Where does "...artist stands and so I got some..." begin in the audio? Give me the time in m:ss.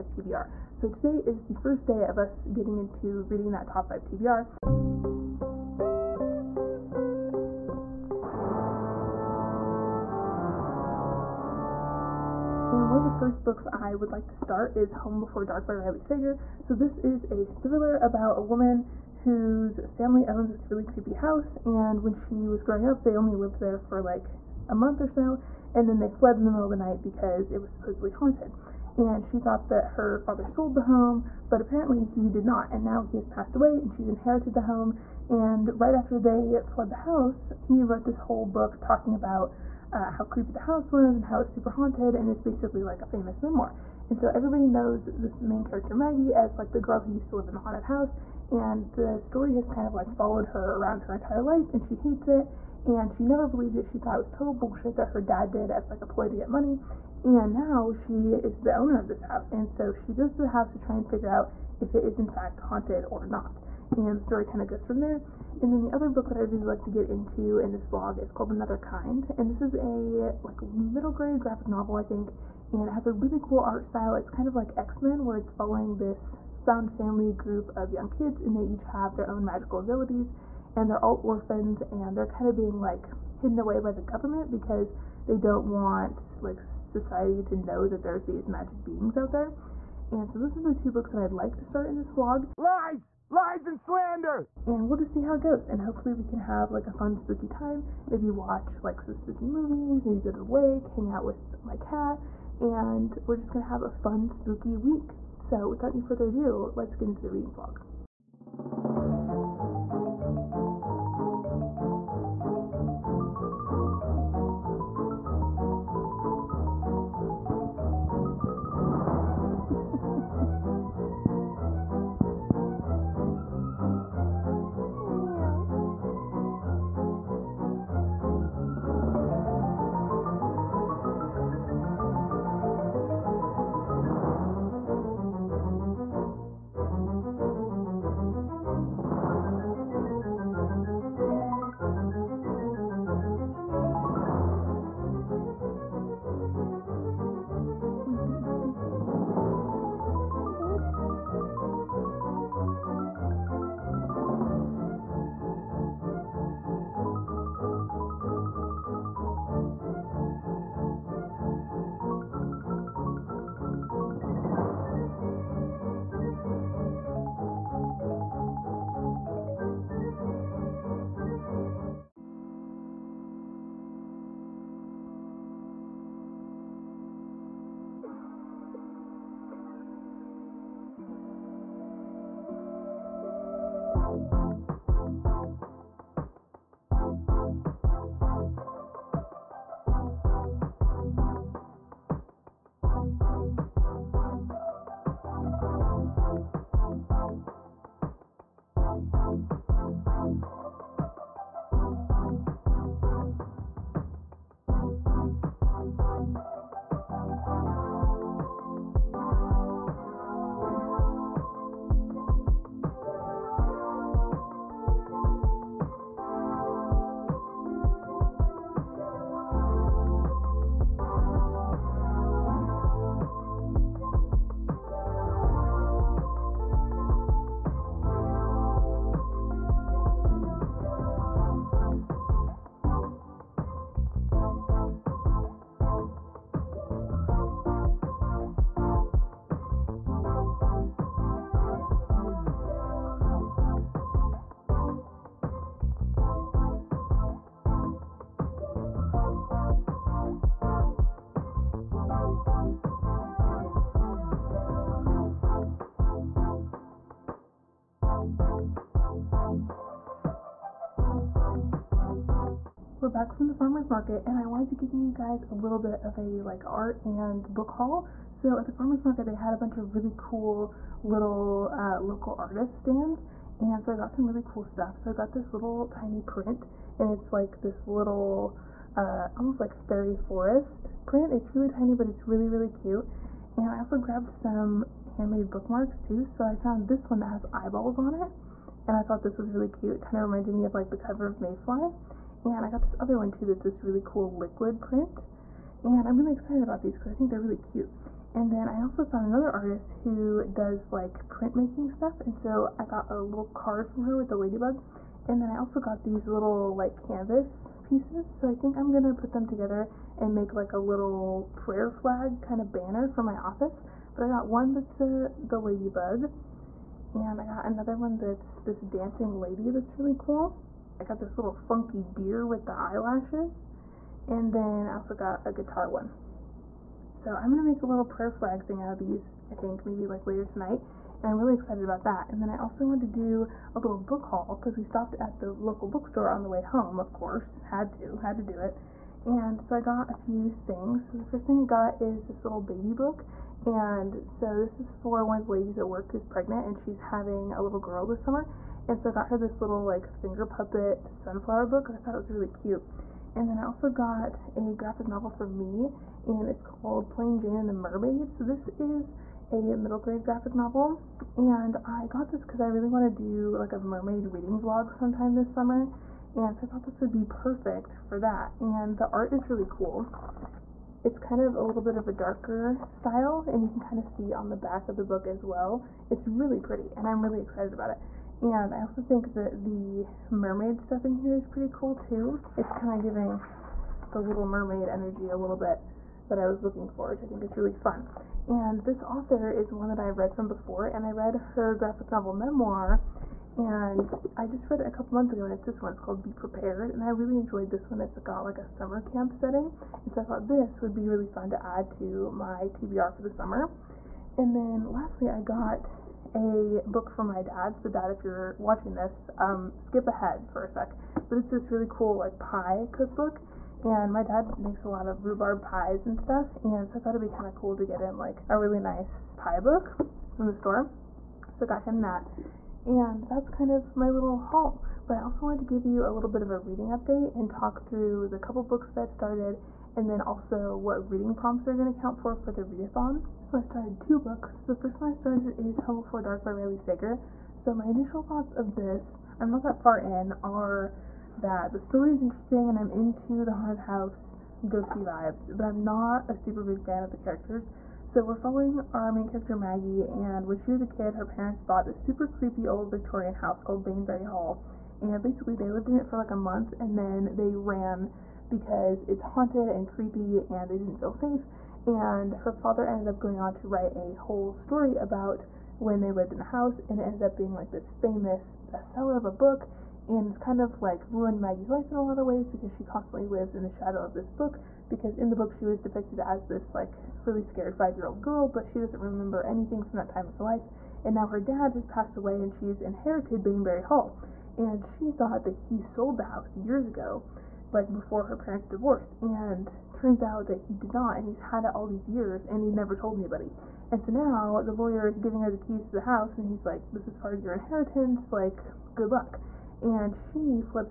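4:32.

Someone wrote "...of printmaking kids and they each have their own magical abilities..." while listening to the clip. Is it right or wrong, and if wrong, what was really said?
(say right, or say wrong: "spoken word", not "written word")
wrong: "young", not "printmaking".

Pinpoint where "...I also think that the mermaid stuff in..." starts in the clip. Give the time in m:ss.
6:18.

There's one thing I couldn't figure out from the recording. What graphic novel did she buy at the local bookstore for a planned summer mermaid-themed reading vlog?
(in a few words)
Plain Jane and the Mermaid.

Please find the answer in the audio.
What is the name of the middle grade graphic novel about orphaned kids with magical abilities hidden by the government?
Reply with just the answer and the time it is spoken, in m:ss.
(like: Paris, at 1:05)
Another Kind, at 1:08.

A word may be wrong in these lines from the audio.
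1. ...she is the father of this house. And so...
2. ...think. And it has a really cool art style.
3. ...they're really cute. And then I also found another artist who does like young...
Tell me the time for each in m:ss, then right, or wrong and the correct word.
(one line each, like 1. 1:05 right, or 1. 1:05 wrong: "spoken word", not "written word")
1. 0:57 wrong: "owner", not "father"
2. 1:12 right
3. 4:57 wrong: "printmaking", not "young".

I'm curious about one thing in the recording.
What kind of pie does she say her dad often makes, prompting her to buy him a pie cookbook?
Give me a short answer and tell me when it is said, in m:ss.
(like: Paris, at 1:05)
Rhubarb, at 6:55.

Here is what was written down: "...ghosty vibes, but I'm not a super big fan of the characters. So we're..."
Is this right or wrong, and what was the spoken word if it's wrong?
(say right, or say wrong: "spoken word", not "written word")
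right.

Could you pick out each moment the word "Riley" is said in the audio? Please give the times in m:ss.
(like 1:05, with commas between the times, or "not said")
0:15, 7:16.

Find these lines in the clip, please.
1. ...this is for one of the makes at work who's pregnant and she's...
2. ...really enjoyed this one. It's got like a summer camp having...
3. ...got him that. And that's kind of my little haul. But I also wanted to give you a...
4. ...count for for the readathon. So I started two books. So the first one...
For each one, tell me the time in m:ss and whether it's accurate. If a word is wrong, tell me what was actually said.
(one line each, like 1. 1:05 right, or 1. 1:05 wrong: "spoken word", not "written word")
1. 5:44 wrong: "ladies", not "makes"
2. 6:37 wrong: "setting", not "having"
3. 7:01 right
4. 7:11 right.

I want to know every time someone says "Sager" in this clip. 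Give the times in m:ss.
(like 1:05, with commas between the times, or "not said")
0:16, 7:16.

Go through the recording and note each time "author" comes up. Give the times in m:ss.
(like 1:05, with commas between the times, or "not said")
6:29.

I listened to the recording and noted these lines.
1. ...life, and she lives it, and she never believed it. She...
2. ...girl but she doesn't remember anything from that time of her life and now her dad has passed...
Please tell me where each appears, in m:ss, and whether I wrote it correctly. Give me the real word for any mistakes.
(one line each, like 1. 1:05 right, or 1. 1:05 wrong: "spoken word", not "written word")
1. 0:51 wrong: "hates", not "lives"
2. 7:58 right.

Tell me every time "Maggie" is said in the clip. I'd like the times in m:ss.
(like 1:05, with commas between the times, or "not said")
0:45, 7:29, 7:51.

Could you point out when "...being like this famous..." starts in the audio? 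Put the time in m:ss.
7:47.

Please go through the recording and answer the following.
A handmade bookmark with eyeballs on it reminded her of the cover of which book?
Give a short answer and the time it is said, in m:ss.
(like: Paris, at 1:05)
Mayfly, at 4:51.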